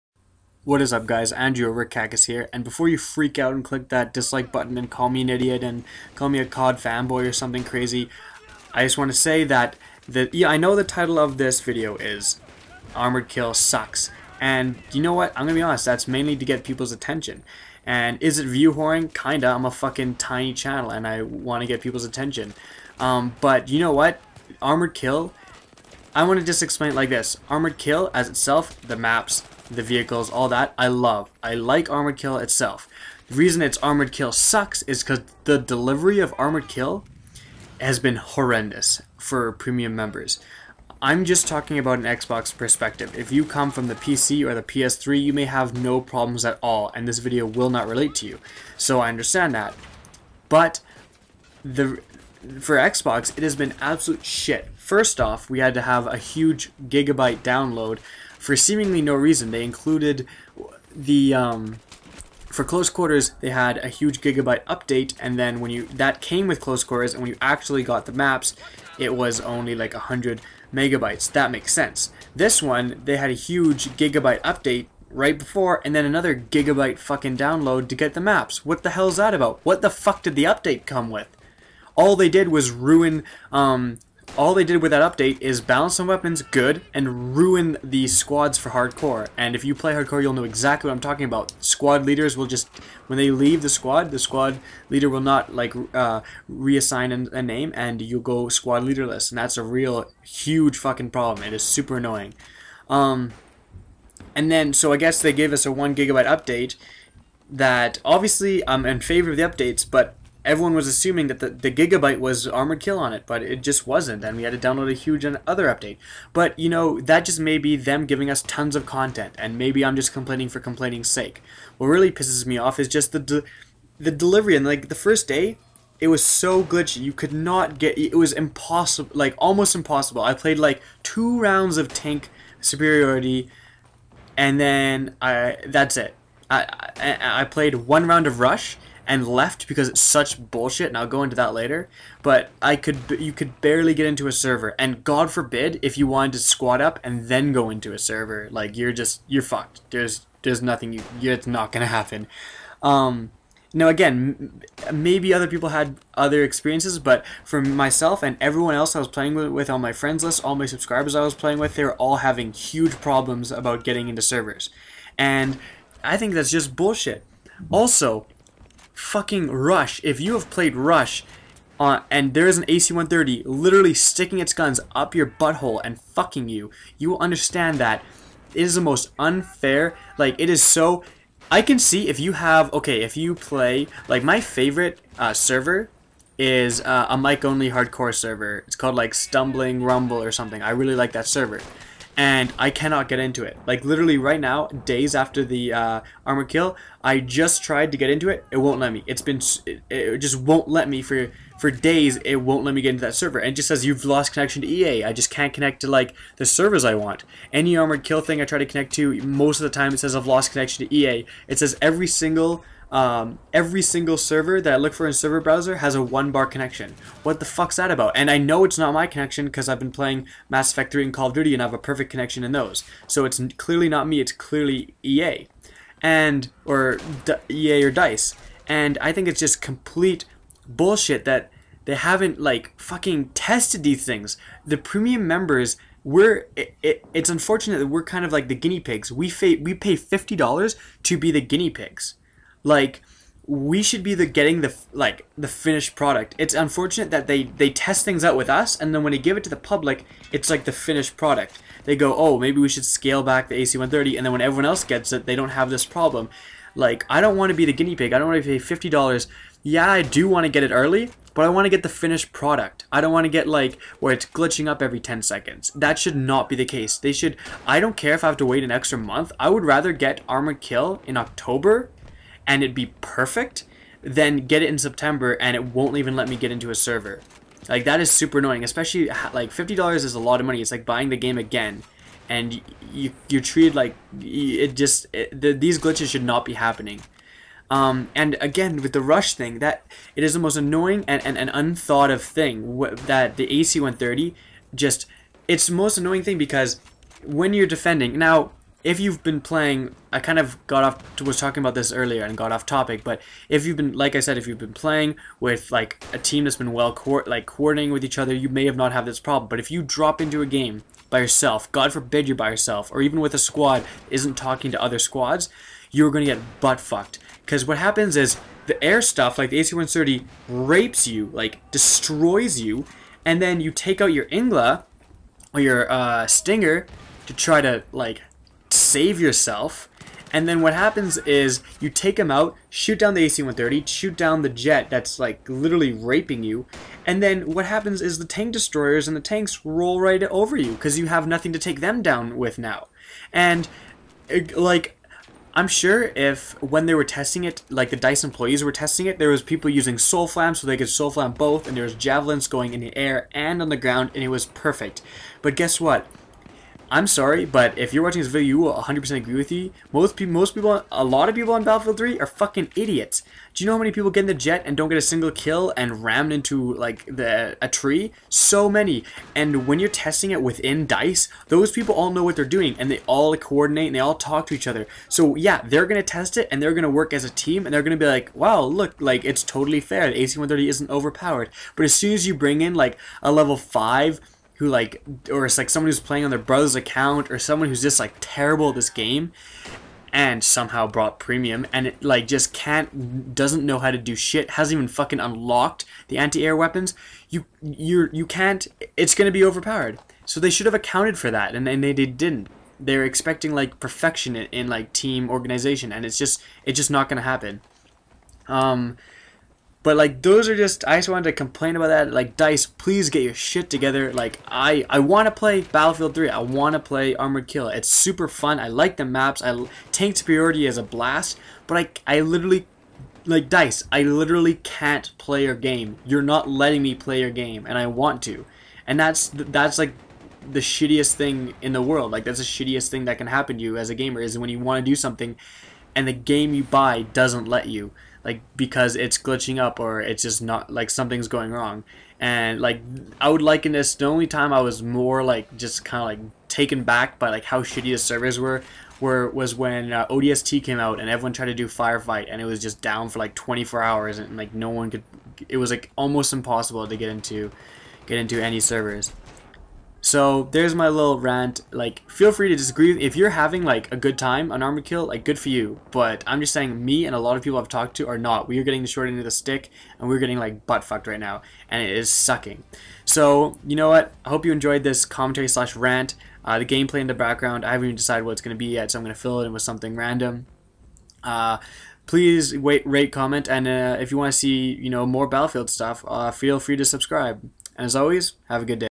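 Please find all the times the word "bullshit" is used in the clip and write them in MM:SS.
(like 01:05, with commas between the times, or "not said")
02:20, 02:46, 03:50.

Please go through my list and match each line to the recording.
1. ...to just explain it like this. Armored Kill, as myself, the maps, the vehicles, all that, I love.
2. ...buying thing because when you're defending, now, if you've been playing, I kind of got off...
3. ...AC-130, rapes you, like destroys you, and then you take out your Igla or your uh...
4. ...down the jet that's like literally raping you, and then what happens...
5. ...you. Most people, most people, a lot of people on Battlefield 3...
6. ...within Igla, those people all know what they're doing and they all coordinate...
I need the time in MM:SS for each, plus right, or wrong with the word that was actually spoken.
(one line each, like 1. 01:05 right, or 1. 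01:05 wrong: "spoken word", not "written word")
1. 00:26 wrong: "itself", not "myself"
2. 04:55 wrong: "annoying", not "buying"
3. 05:19 right
4. 05:34 right
5. 05:59 right
6. 06:10 wrong: "Dice", not "Igla".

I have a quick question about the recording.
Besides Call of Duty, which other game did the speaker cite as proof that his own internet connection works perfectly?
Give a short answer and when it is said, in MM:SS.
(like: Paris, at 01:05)
Mass Effect 3, at 03:40.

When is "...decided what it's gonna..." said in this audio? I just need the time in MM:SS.
07:57.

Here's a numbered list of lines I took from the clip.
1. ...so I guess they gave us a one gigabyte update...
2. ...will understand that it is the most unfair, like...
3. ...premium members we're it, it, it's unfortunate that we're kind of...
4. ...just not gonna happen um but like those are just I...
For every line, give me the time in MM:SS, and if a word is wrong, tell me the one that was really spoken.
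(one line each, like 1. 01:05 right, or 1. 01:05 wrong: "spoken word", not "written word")
1. 01:44 right
2. 02:57 right
3. 03:54 right
4. 06:46 right.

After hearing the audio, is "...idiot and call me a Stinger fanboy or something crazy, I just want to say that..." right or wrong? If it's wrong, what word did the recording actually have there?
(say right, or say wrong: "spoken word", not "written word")
wrong: "COD", not "Stinger".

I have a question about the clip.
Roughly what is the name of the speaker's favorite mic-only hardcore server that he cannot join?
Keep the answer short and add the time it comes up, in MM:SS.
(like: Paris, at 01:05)
Stumbling Rumble, at 03:09.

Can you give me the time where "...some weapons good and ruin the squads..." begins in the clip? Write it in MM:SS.
01:25.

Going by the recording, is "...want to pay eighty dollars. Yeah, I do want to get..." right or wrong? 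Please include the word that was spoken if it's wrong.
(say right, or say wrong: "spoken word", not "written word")
wrong: "fifty", not "eighty".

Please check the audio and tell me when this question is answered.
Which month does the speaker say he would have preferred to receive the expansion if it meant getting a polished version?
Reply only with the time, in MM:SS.
04:31.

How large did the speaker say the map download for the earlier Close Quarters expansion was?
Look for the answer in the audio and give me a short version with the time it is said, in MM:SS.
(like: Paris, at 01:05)
100 megabytes, at 01:09.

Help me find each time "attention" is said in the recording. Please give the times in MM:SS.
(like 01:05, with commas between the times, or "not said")
00:16, 00:22.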